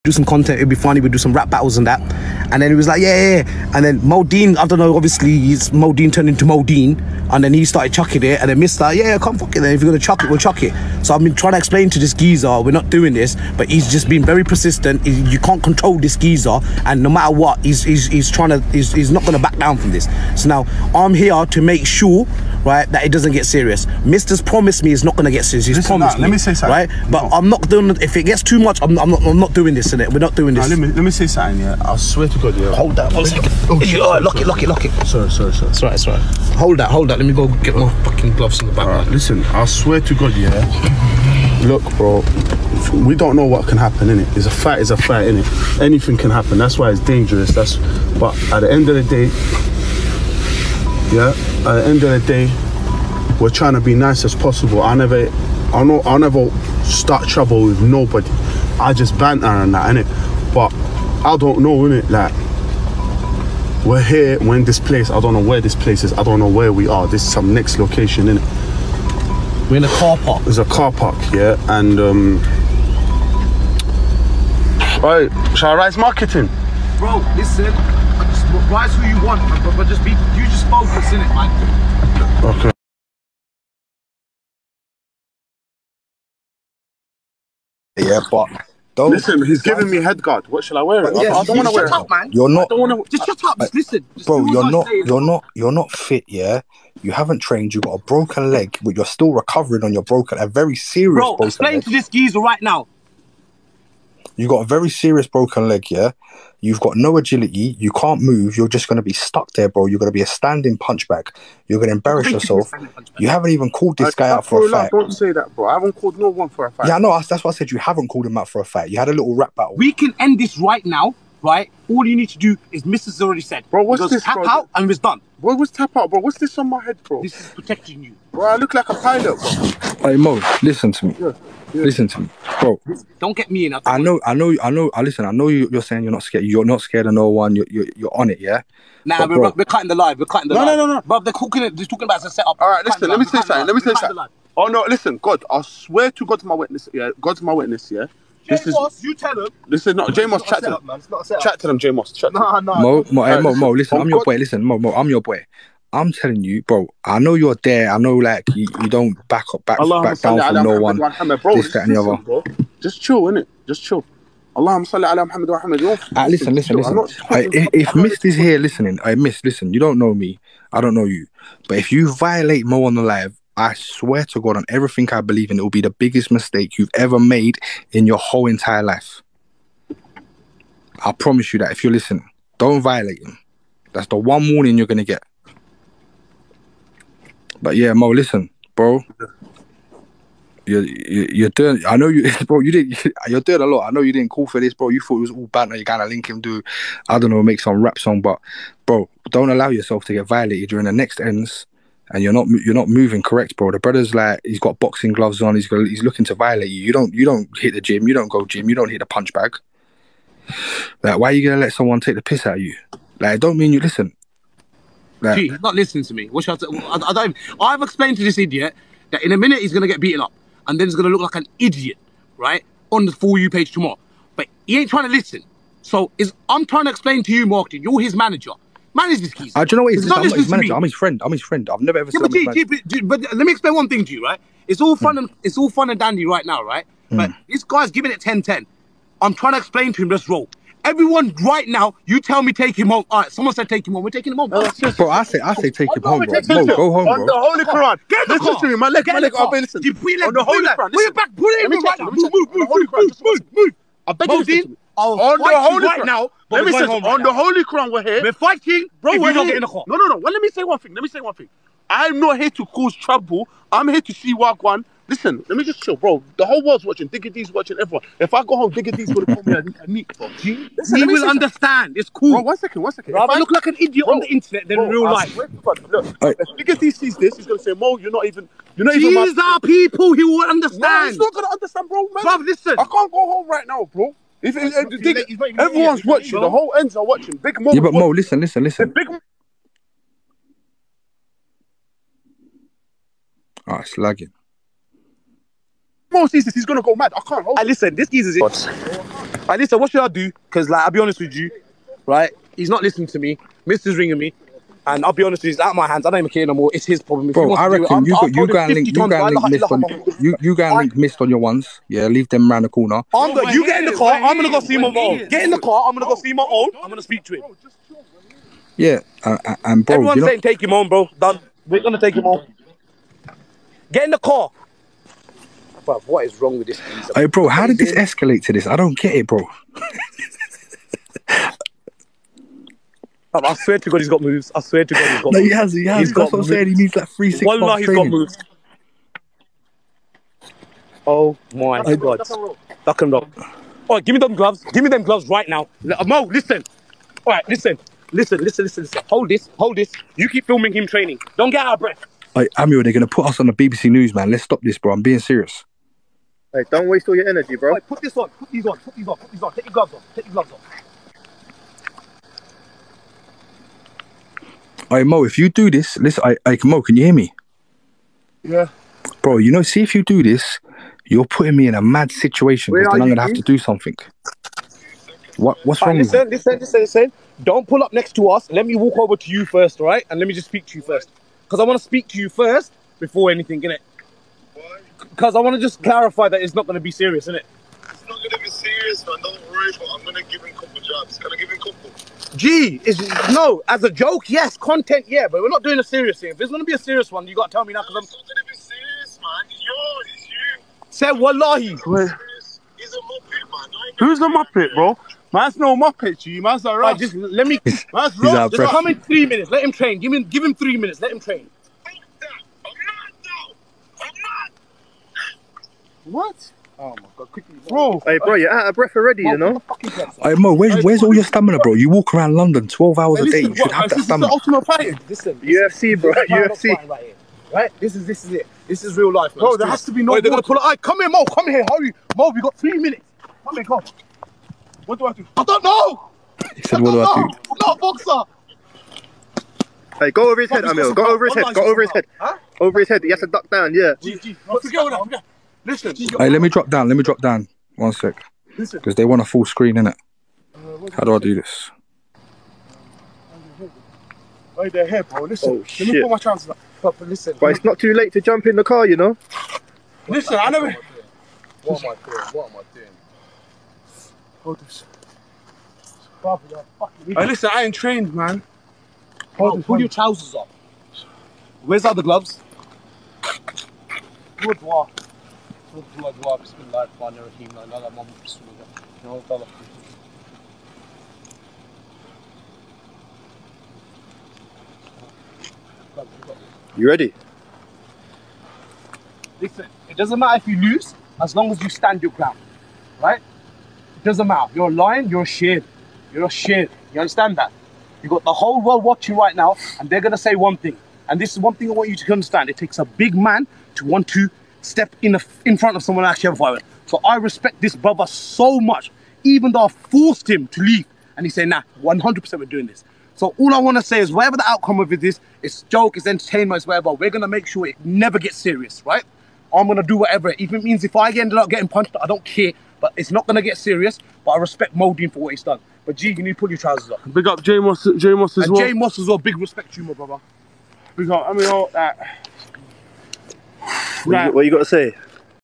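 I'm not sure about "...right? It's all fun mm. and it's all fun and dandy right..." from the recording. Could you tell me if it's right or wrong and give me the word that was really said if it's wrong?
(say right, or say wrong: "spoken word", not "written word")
right.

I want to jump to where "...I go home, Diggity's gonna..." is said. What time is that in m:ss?
4:28.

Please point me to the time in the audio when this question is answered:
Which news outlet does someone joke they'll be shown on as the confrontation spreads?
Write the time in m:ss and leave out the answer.
5:53.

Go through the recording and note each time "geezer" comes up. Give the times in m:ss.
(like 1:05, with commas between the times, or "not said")
0:12, 0:16, 1:42.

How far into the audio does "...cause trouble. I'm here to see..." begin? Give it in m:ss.
4:22.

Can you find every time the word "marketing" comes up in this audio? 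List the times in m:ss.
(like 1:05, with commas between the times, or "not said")
1:15, 3:47.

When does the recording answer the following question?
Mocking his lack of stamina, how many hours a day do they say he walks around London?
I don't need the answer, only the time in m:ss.
7:02.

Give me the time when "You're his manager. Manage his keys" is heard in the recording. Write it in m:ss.
3:47.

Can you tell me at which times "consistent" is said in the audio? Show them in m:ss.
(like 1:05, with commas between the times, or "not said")
not said.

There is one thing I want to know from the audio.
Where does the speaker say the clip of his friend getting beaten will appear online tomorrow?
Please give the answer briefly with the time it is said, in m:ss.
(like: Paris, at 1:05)
For You page, at 3:43.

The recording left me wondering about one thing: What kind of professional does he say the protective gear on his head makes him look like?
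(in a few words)
pilot.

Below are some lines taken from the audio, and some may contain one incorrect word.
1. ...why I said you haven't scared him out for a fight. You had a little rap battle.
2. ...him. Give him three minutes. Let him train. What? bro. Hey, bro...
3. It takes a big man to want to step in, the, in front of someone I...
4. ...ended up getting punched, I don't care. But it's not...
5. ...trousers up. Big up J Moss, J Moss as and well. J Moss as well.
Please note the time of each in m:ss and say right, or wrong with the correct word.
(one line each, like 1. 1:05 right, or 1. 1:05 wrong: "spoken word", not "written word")
1. 1:57 wrong: "called", not "scared"
2. 6:50 right
3. 8:22 right
4. 8:41 right
5. 8:46 right.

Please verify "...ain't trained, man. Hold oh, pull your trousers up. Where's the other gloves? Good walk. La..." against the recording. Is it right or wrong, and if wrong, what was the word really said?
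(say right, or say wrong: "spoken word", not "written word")
right.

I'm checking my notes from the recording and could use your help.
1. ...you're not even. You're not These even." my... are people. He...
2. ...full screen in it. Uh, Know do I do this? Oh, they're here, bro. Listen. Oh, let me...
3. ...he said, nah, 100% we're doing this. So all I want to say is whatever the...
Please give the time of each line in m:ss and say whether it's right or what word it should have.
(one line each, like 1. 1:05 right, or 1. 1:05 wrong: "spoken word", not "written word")
1. 4:37 right
2. 7:29 wrong: "How", not "Know"
3. 8:31 right.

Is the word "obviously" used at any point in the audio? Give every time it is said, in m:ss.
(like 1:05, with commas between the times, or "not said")
0:04.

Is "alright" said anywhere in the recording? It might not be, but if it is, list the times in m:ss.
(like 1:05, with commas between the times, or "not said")
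6:46.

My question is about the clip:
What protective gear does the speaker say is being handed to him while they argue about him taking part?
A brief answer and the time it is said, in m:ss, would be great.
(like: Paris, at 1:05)
head guard, at 1:29.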